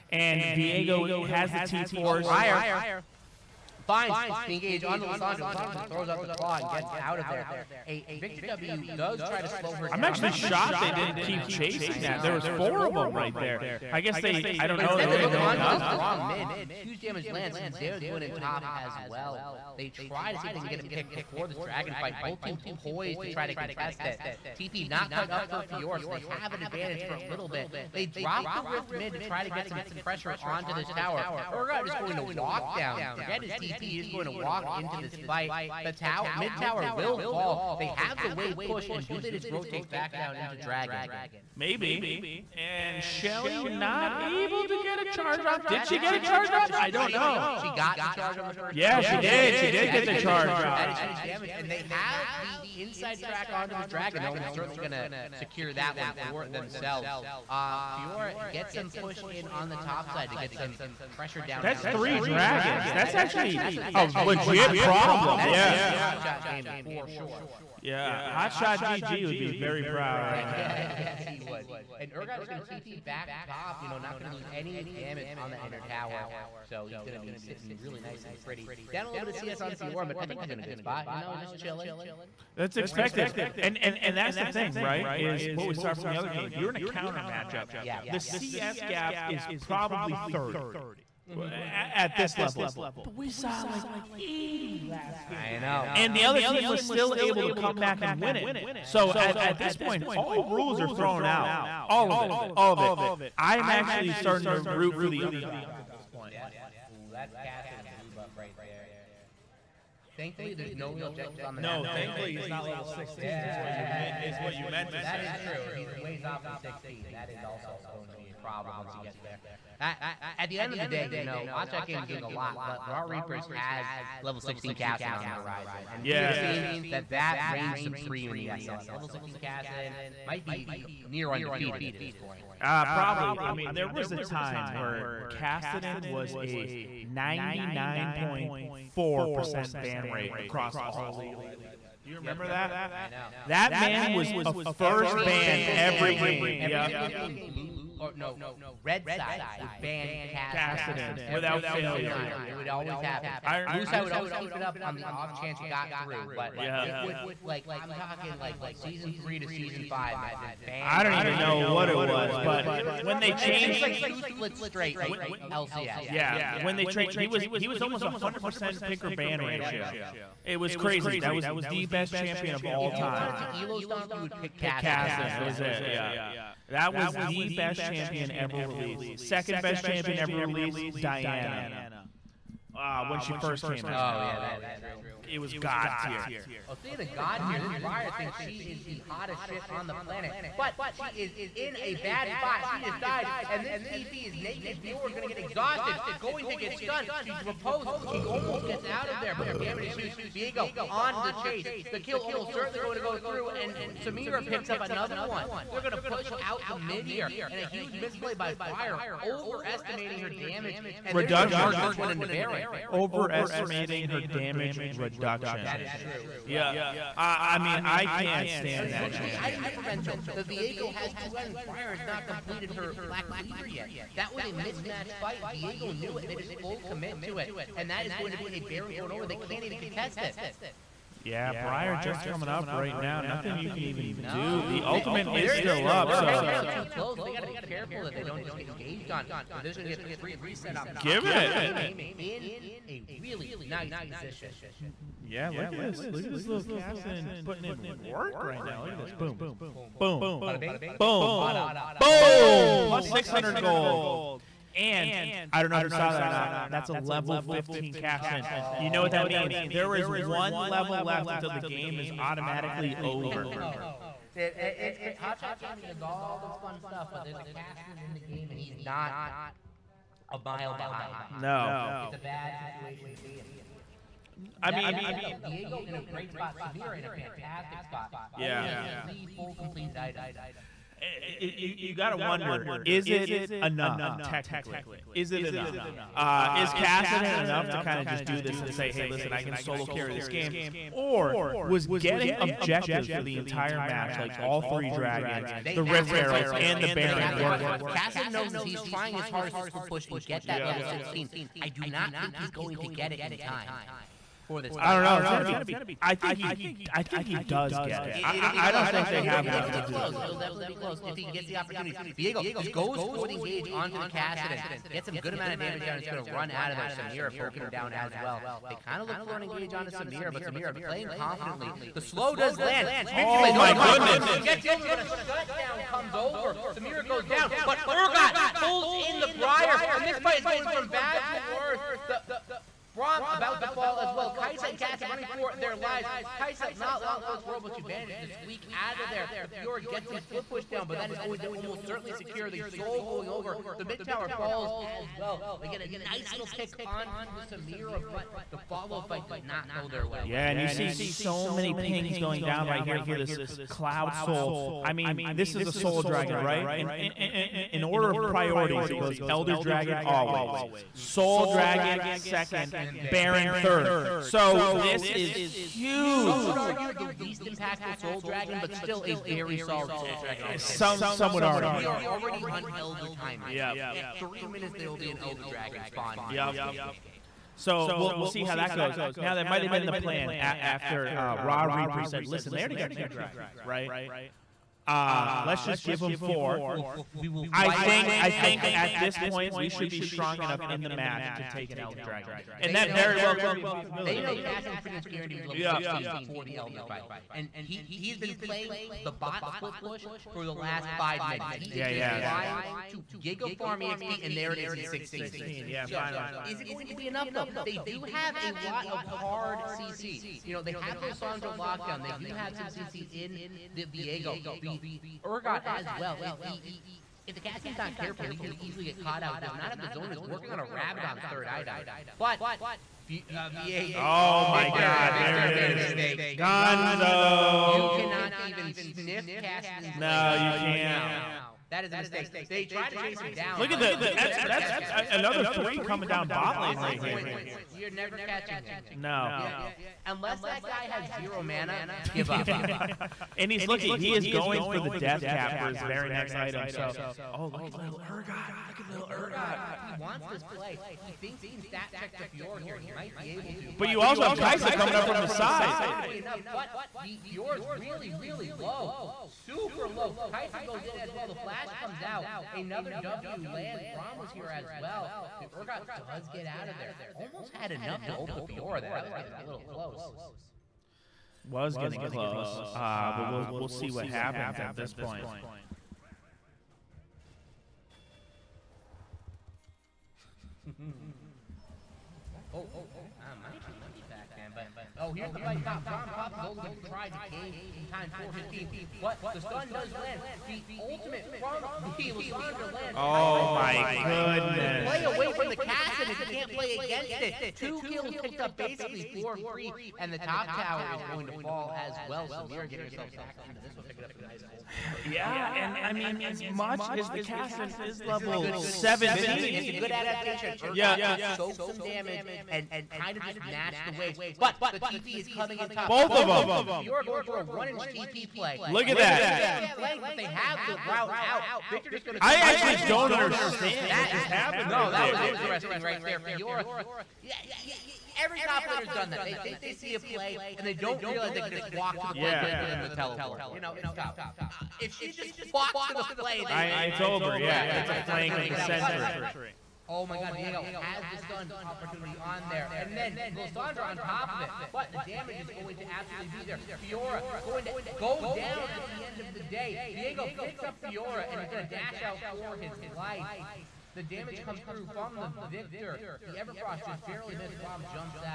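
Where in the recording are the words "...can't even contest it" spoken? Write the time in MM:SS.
03:49.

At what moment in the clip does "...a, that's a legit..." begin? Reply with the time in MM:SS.
01:03.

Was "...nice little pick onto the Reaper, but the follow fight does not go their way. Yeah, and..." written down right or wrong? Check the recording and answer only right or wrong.
wrong.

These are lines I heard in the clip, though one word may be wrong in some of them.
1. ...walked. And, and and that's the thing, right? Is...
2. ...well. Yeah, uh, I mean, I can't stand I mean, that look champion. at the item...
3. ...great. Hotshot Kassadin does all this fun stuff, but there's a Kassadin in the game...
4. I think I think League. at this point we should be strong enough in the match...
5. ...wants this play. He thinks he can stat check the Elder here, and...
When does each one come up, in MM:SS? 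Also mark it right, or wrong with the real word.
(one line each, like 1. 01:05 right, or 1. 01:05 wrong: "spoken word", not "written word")
1. 01:22 wrong: "expected", not "walked"
2. 03:36 right
3. 04:24 wrong: "Gaming", not "Kassadin"
4. 06:27 wrong: "Elder", not "League"
5. 07:29 wrong: "Fior", not "Elder".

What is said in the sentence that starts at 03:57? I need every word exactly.
They got to be careful that they don't just get engaged on.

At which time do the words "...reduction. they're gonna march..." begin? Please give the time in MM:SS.
03:31.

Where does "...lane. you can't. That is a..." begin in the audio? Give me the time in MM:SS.
07:10.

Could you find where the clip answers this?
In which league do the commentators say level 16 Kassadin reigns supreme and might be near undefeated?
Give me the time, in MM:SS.
02:08.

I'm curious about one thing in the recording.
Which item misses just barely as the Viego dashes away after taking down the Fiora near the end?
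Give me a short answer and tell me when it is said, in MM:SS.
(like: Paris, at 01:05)
Everfrost, at 09:16.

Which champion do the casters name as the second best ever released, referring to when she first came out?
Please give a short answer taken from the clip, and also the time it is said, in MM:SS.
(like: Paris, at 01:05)
Diana, at 03:00.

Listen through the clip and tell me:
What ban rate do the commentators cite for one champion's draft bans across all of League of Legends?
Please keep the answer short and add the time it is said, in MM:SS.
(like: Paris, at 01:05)
99.4%, at 02:17.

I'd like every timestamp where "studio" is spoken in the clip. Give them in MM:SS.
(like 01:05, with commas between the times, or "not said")
not said.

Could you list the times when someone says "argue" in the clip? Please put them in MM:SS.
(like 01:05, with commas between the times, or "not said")
06:06, 06:11.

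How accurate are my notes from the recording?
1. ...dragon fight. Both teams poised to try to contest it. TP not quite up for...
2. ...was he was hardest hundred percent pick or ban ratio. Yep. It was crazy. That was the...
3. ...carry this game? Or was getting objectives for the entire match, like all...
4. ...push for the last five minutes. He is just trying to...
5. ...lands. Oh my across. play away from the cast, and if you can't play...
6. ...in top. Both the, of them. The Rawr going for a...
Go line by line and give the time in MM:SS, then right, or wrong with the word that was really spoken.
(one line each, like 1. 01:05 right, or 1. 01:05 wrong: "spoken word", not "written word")
1. 00:21 right
2. 02:47 wrong: "almost", not "hardest"
3. 04:49 right
4. 06:39 right
5. 08:12 wrong: "goodness", not "across"
6. 08:35 wrong: "Fiora", not "Rawr".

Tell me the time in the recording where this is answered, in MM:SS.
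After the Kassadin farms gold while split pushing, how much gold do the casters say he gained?
04:13.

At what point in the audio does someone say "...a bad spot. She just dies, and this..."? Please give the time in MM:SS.
03:11.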